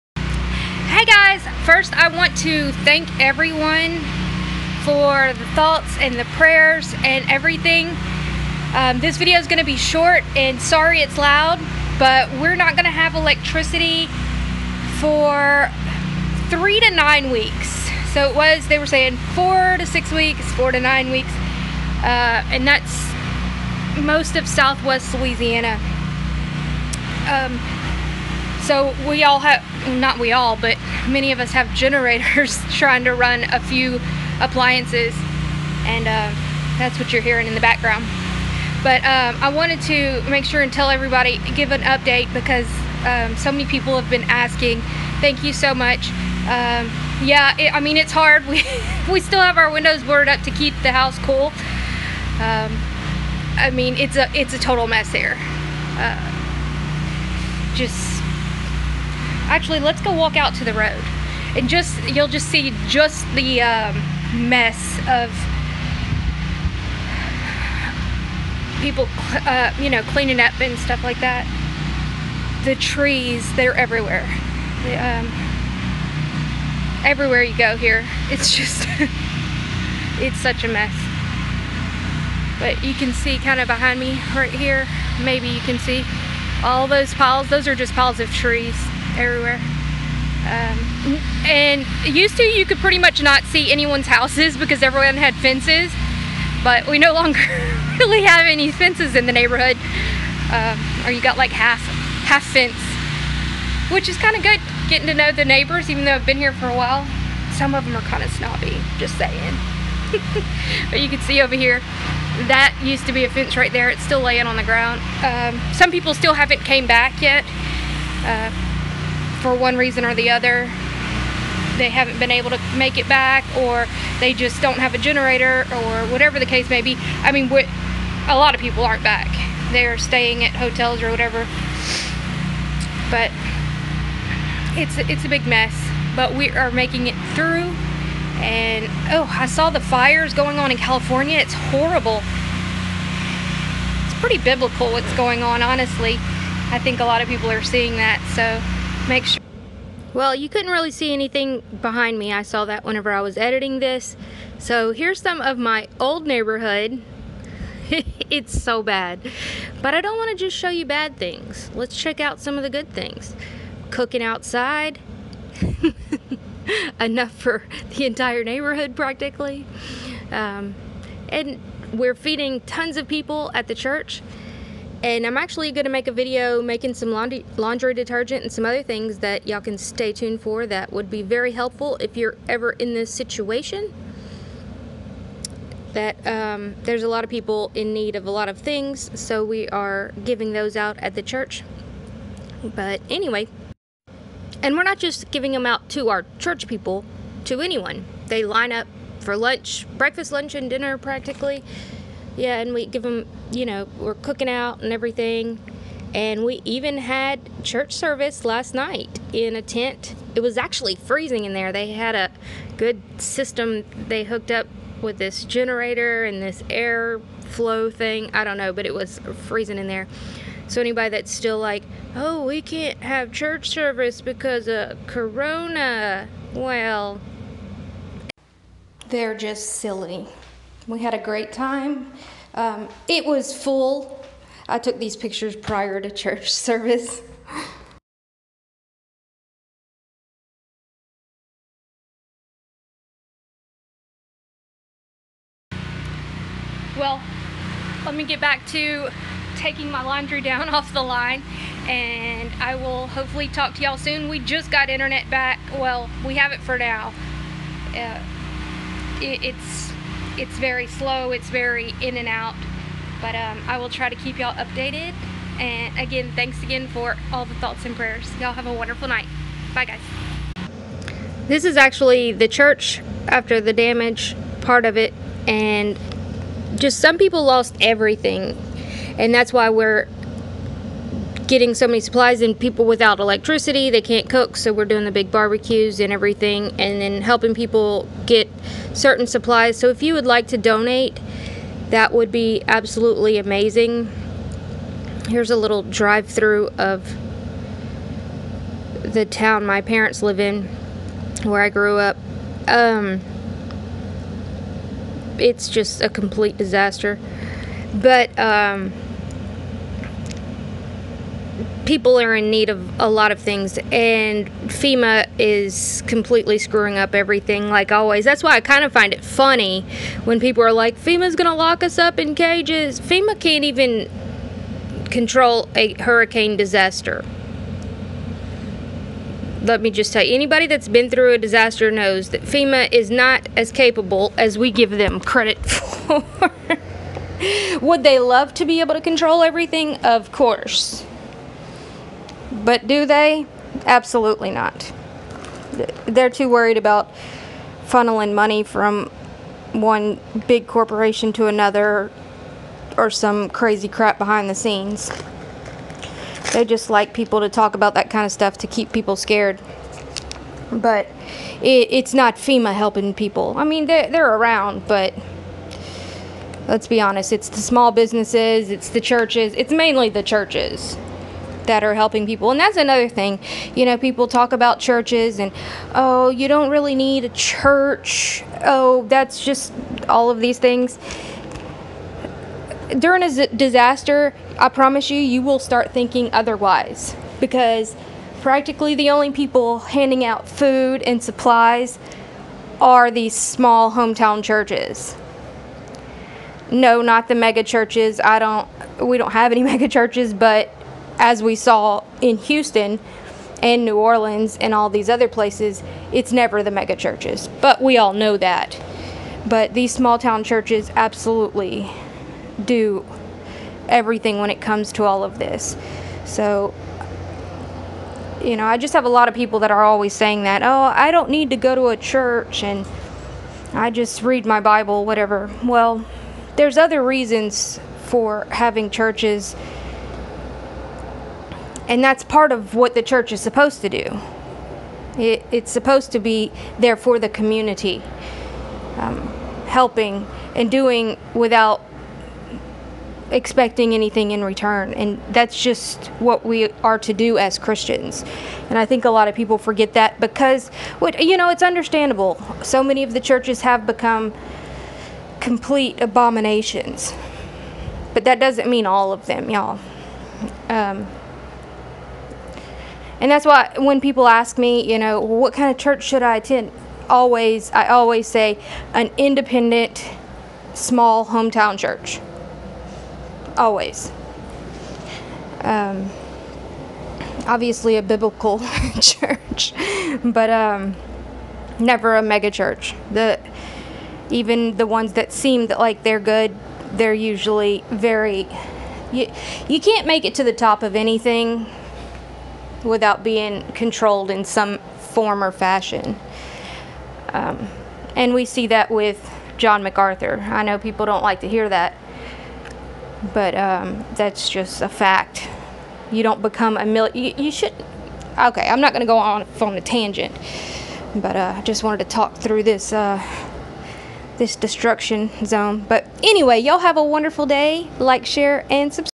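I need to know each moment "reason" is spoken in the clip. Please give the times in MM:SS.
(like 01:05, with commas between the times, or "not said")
01:59, 07:07.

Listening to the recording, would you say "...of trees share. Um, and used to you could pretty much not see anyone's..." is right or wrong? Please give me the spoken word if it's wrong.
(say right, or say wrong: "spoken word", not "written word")
wrong: "everywhere", not "share".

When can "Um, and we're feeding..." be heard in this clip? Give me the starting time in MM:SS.
02:50.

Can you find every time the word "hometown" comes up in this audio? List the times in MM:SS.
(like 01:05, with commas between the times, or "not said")
06:33, 07:51.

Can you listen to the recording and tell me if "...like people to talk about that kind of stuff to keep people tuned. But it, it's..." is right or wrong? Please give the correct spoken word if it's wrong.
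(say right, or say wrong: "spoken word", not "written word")
wrong: "scared", not "tuned".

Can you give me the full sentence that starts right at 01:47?
Some of them are kind of snobby, just saying.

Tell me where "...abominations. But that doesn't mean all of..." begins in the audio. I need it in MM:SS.
07:36.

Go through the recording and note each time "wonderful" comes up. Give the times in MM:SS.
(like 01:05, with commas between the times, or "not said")
04:28, 08:37.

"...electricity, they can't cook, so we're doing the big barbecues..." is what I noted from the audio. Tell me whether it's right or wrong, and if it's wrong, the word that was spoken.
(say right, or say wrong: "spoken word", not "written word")
right.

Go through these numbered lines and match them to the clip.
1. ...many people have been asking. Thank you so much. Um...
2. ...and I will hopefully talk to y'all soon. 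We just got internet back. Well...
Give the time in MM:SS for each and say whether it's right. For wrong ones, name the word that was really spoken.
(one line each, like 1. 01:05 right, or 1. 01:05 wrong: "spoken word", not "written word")
1. 00:43 right
2. 04:11 right.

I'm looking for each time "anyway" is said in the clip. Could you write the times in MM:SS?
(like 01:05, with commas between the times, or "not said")
03:13, 08:36.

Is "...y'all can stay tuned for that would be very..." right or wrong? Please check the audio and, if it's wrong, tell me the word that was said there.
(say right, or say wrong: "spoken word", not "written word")
right.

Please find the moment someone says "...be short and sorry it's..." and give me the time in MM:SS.
00:09.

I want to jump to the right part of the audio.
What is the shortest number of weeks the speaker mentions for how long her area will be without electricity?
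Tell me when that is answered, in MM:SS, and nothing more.
00:16.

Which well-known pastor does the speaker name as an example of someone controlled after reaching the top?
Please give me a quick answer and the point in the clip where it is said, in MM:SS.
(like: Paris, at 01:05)
John MacArthur, at 08:19.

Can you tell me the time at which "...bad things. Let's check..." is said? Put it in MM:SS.
02:40.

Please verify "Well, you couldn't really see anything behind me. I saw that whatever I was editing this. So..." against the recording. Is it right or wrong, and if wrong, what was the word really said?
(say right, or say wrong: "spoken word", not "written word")
wrong: "whenever", not "whatever".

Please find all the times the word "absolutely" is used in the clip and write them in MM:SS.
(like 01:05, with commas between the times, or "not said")
04:52, 05:43, 06:50.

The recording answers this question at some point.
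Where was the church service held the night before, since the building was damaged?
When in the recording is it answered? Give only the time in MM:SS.
03:29.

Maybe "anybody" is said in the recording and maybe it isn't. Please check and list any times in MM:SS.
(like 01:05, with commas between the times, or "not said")
03:40, 05:30.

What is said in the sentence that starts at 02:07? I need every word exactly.
I mean, a lot of people aren't back.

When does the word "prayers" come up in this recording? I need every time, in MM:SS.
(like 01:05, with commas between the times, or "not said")
00:06, 04:27.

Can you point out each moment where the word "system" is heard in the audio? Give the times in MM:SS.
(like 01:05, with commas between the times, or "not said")
03:33.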